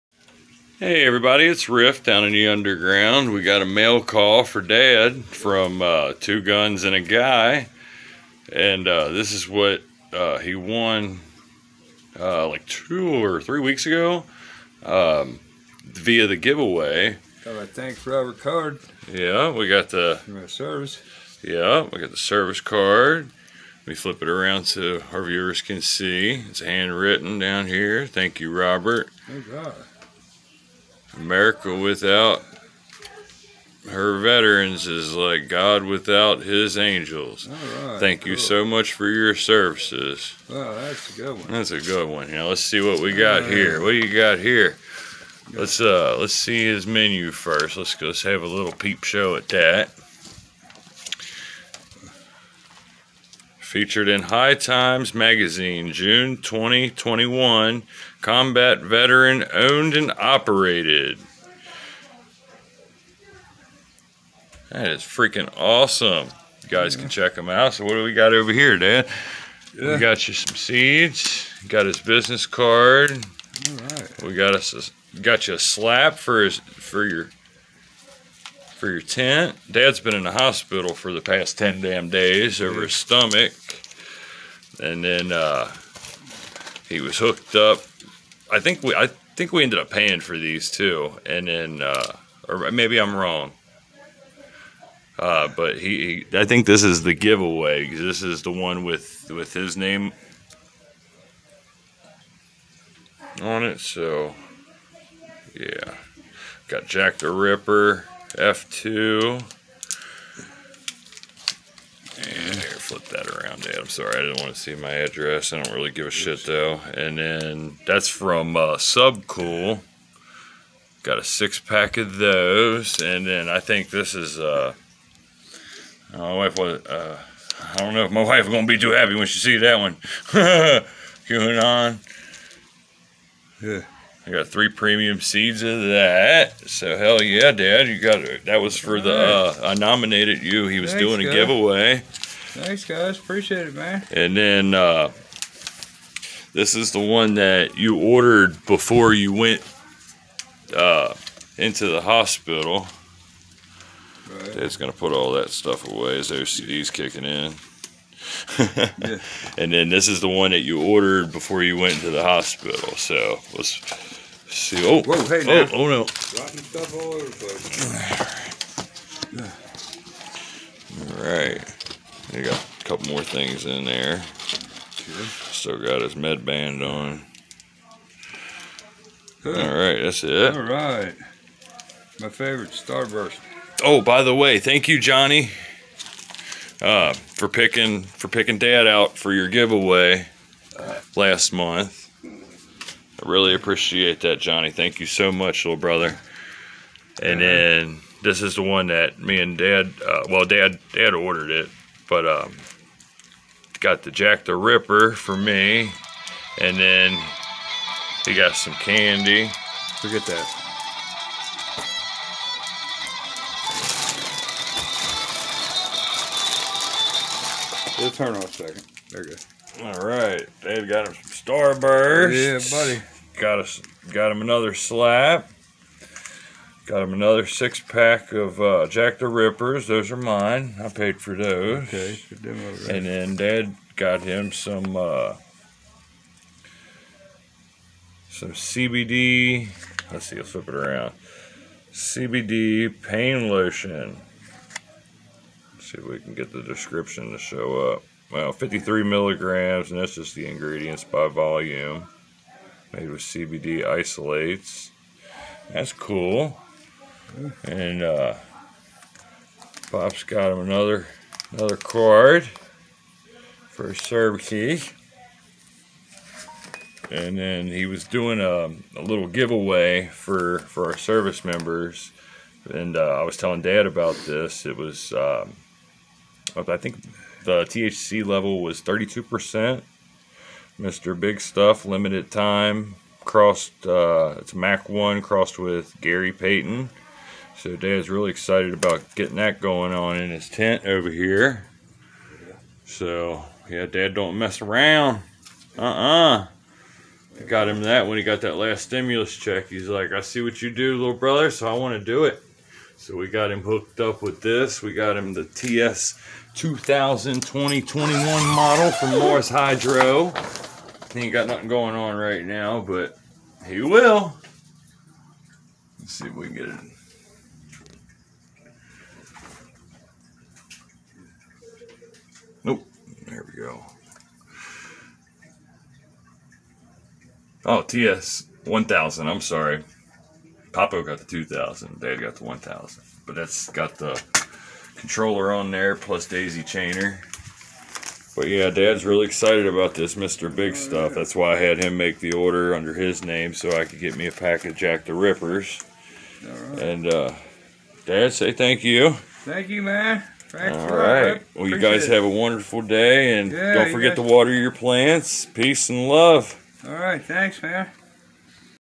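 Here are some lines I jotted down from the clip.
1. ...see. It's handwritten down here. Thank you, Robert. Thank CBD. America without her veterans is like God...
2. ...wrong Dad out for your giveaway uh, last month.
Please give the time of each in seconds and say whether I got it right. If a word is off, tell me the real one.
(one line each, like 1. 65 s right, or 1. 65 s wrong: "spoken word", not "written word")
1. 25 s wrong: "God", not "CBD"
2. 188 s wrong: "picking", not "wrong".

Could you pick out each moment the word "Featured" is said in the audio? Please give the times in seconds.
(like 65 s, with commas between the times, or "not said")
53 s.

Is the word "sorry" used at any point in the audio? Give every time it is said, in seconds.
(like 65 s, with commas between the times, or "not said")
113 s, 329 s.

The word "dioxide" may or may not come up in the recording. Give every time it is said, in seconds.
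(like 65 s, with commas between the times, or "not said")
not said.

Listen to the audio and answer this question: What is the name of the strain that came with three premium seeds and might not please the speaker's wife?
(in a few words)
QAnon.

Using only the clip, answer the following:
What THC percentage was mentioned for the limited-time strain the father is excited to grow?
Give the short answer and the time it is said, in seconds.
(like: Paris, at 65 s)
32%, at 278 s.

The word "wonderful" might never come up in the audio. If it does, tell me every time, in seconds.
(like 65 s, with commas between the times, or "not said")
352 s.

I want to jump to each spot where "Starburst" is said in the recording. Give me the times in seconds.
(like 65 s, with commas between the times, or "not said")
182 s, 221 s.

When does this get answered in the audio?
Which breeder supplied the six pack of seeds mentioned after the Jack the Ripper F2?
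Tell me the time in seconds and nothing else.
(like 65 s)
118 s.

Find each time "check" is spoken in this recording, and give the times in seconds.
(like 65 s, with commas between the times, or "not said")
67 s, 299 s.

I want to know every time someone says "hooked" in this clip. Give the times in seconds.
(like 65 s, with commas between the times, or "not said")
87 s, 303 s.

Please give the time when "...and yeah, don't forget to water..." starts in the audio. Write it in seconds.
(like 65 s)
353 s.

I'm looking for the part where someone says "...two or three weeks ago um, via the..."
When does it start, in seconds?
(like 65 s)
12 s.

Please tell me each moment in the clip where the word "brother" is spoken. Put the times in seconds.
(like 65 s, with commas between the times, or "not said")
195 s, 301 s.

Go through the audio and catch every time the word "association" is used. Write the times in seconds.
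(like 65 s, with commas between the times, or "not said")
not said.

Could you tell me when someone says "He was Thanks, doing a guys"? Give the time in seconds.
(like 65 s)
140 s.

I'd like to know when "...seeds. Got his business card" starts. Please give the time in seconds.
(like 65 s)
70 s.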